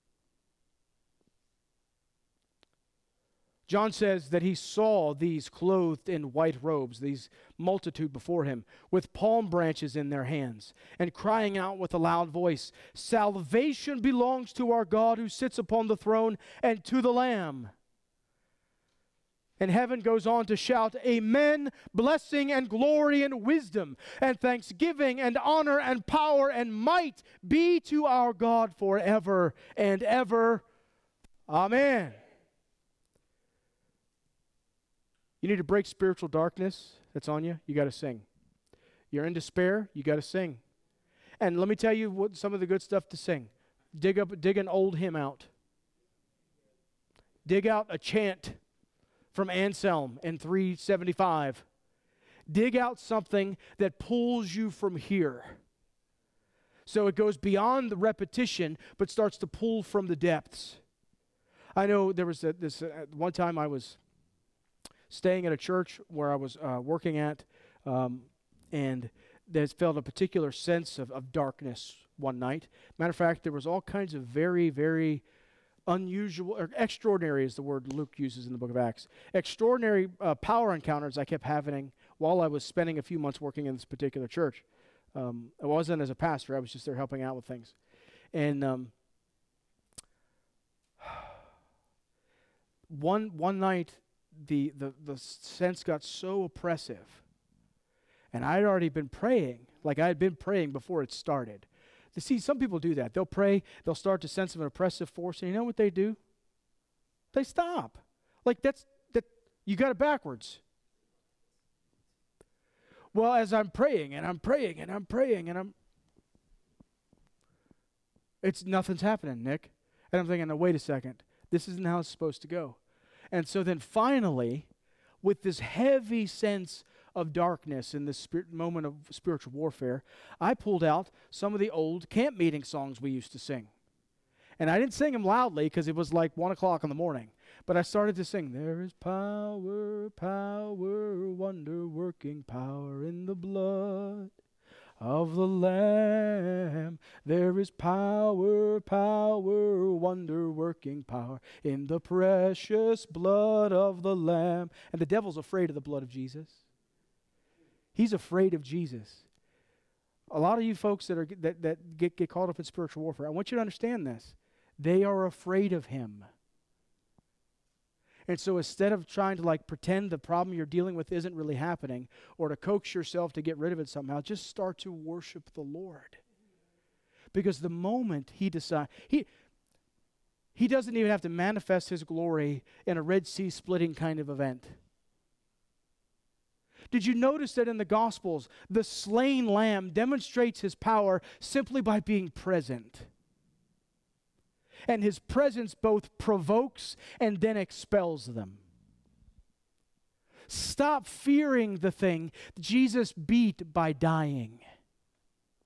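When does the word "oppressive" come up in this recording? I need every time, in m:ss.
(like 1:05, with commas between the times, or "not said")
1:36, 1:44.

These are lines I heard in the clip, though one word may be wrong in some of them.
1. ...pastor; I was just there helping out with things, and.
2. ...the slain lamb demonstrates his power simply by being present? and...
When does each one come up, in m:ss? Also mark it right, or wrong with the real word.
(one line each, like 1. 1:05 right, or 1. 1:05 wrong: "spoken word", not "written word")
1. 1:26 right
2. 3:08 right.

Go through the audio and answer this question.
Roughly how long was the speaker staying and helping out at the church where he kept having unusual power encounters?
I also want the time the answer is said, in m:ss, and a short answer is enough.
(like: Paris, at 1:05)
a few months, at 1:22.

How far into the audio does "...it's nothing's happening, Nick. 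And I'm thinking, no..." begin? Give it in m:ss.
1:58.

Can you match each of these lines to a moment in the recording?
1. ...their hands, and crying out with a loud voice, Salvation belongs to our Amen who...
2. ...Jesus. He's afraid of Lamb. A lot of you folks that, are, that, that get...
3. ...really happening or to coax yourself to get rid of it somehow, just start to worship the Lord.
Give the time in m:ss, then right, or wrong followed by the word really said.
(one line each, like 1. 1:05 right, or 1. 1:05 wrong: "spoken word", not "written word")
1. 0:10 wrong: "God", not "Amen"
2. 2:36 wrong: "Jesus", not "Lamb"
3. 2:51 right.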